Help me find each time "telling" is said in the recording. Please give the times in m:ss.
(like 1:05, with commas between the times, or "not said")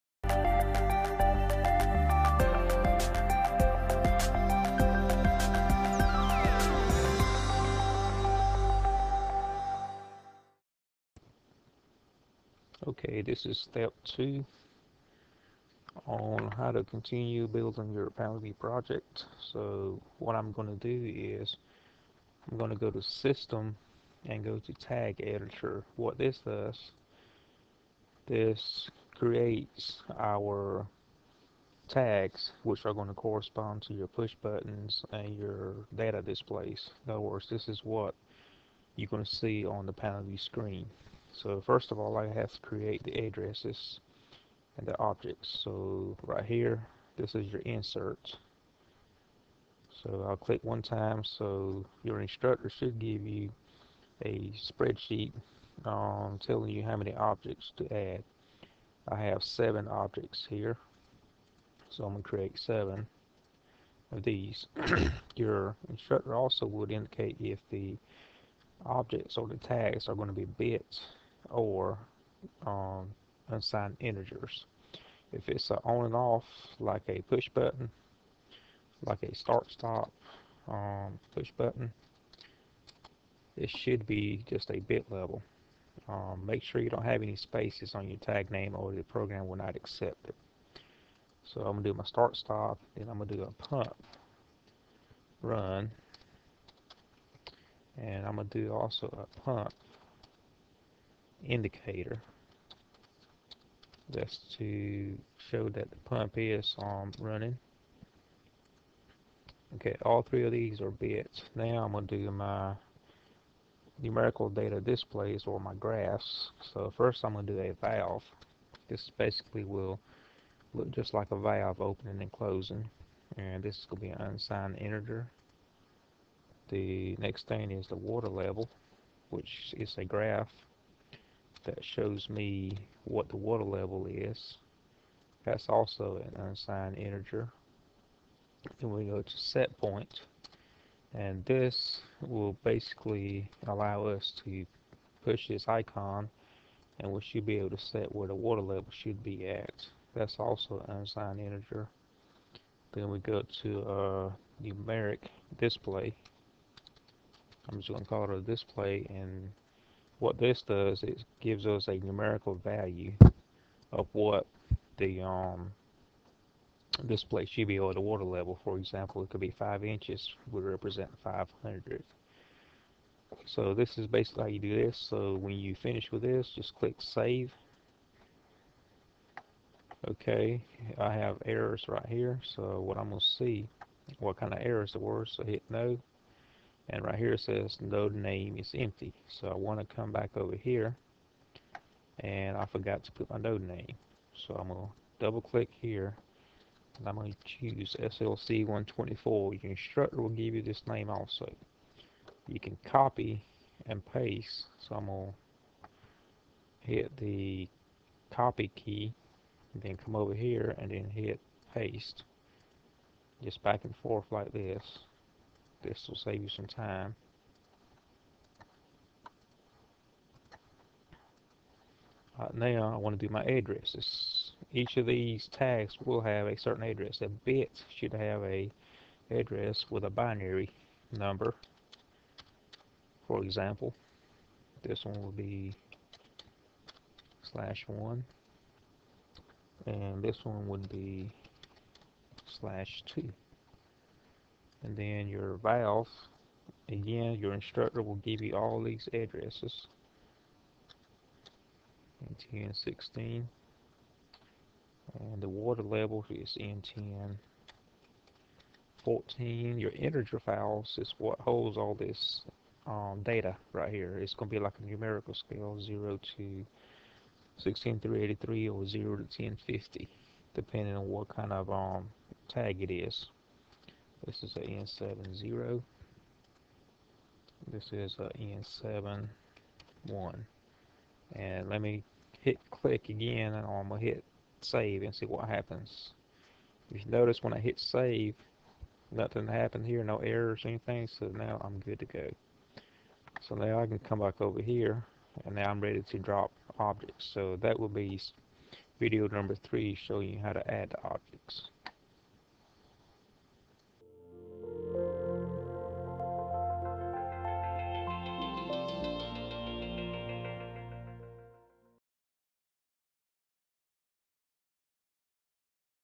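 0:56.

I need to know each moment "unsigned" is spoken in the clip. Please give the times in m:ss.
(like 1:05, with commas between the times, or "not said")
1:13, 2:04, 2:16, 2:30.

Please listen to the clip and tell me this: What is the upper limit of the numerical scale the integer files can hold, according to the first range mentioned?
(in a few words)
16383.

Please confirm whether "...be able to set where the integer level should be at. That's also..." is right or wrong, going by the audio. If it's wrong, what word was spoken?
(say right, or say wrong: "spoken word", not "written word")
wrong: "water", not "integer".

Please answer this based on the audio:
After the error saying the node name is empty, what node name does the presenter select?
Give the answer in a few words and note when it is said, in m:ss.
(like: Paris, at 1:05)
SLC 124, at 3:17.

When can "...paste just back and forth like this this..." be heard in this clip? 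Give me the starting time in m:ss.
3:31.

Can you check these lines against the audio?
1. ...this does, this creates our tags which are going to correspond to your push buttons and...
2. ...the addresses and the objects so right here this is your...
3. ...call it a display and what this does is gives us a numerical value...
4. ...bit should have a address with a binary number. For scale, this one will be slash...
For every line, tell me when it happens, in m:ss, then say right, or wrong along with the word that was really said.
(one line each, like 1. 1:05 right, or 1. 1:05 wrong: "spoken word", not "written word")
1. 0:26 right
2. 0:43 right
3. 2:38 right
4. 3:47 wrong: "example", not "scale".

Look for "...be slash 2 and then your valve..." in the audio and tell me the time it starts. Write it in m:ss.
4:00.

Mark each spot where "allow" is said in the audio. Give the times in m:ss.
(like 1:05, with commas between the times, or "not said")
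2:23.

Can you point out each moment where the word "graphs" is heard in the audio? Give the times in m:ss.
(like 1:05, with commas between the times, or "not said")
1:55, 2:10.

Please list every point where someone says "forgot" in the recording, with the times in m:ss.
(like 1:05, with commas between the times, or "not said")
3:12.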